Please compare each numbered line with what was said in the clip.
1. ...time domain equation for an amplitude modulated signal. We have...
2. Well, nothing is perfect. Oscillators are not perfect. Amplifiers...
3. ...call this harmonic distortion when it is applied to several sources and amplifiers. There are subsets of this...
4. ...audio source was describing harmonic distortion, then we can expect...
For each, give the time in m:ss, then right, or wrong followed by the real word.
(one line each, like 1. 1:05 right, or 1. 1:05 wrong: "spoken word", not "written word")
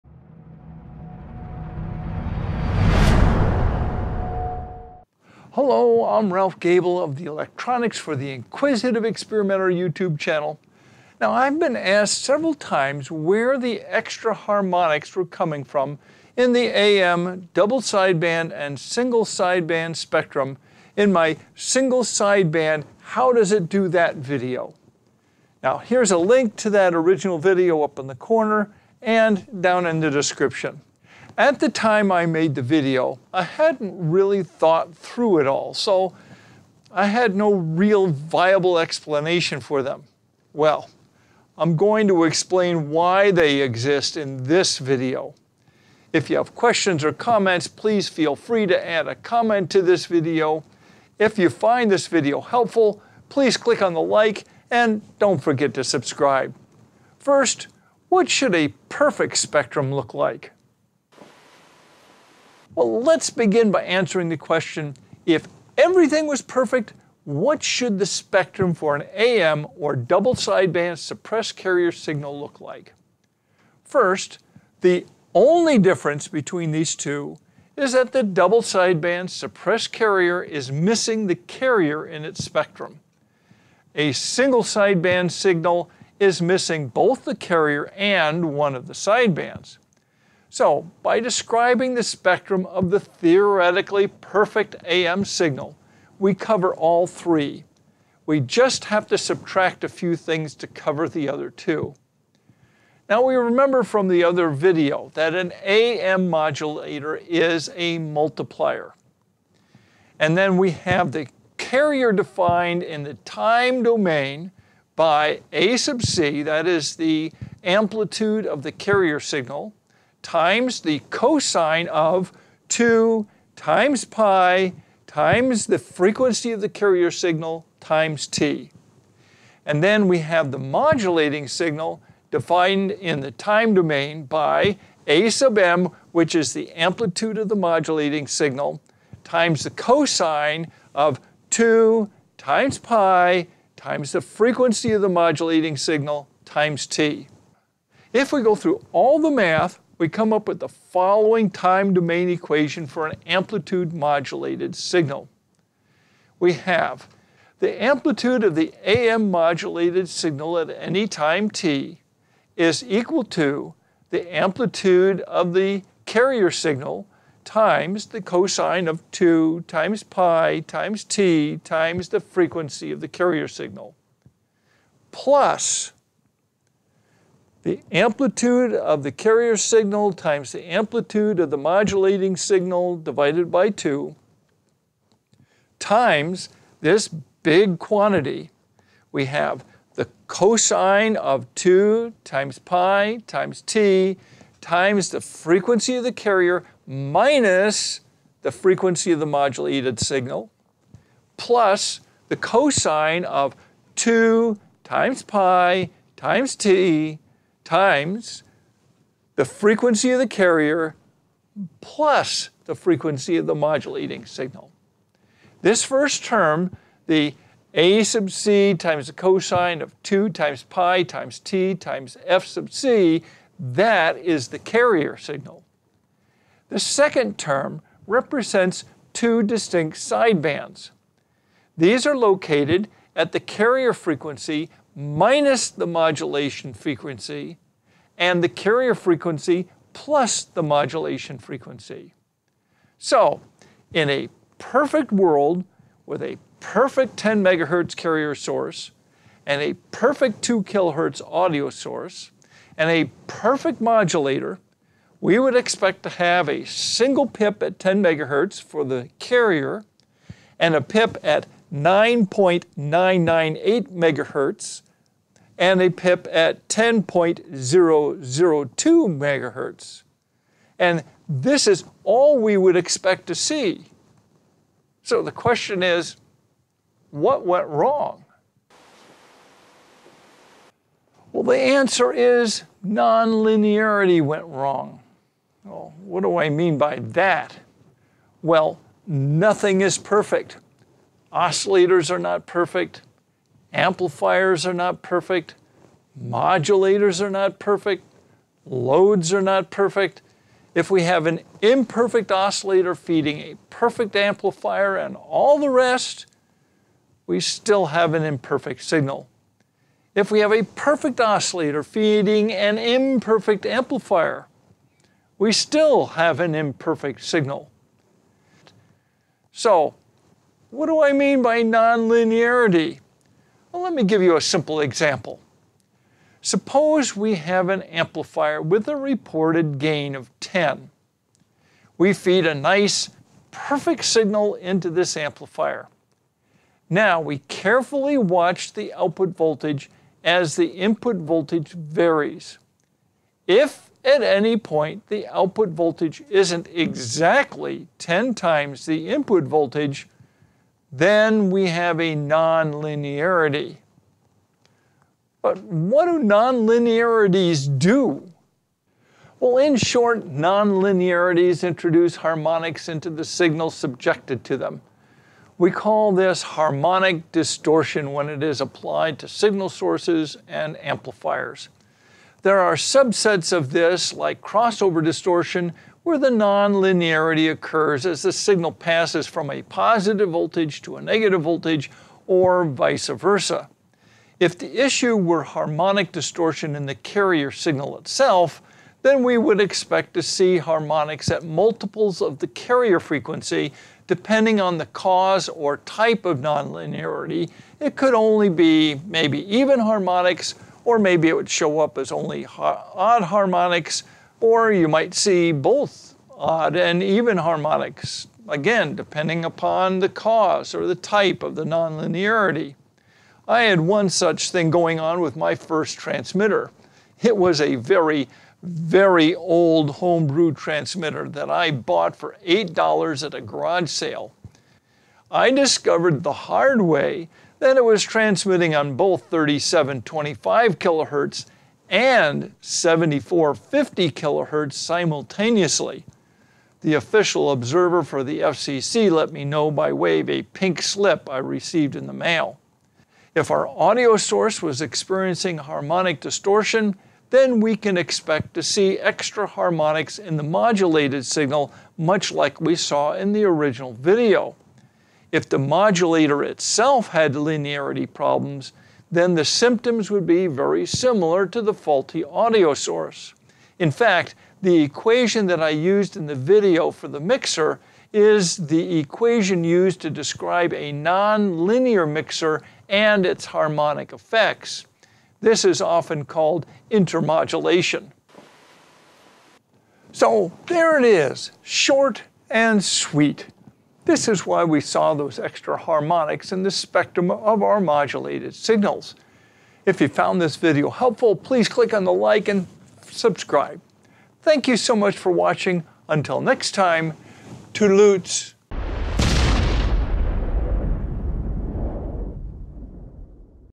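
1. 2:31 right
2. 4:48 right
3. 6:05 wrong: "signal", not "several"
4. 7:23 wrong: "experiencing", not "describing".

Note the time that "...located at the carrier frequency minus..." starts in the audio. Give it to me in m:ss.
3:52.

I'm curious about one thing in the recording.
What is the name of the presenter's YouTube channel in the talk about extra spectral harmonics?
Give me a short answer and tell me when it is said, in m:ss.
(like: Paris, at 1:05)
Electronics for the Inquisitive Experimenter, at 0:07.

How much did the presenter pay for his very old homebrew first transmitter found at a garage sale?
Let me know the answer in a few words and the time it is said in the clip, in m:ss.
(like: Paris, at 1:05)
$8, at 7:02.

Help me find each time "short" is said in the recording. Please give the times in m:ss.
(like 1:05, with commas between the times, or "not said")
5:59, 8:01.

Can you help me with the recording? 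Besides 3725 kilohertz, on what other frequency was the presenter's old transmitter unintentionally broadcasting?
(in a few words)
7450 kilohertz.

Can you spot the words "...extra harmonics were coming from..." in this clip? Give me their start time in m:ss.
0:13.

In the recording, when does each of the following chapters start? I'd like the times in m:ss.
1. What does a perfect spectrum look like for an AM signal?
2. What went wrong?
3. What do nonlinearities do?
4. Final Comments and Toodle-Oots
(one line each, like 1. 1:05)
1. 1:02
2. 4:40
3. 5:59
4. 7:59.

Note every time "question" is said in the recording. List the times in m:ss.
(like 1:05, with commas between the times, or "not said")
0:46, 1:04, 4:35.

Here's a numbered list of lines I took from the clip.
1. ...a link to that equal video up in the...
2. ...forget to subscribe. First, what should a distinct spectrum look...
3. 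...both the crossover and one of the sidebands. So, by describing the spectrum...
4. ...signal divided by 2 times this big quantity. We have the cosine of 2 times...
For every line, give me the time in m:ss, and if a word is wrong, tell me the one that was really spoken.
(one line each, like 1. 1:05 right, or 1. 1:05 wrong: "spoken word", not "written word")
1. 0:26 wrong: "original", not "equal"
2. 0:55 wrong: "perfect", not "distinct"
3. 1:26 wrong: "carrier", not "crossover"
4. 3:02 right.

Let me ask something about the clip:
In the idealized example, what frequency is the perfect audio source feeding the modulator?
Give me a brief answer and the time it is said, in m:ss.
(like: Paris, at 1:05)
2 kilohertz, at 4:10.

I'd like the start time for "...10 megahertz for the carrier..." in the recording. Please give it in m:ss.
4:17.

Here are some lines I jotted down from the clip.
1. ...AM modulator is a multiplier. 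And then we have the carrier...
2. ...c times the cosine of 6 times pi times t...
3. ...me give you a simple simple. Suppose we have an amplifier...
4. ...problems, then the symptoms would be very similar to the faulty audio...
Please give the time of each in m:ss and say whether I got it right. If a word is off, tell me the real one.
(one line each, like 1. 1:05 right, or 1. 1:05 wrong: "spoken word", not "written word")
1. 1:45 right
2. 3:38 wrong: "2", not "6"
3. 5:23 wrong: "example", not "simple"
4. 7:38 right.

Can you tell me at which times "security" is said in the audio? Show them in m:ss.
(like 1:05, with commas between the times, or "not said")
not said.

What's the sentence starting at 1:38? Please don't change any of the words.
We just have to subtract a few things to cover the other two.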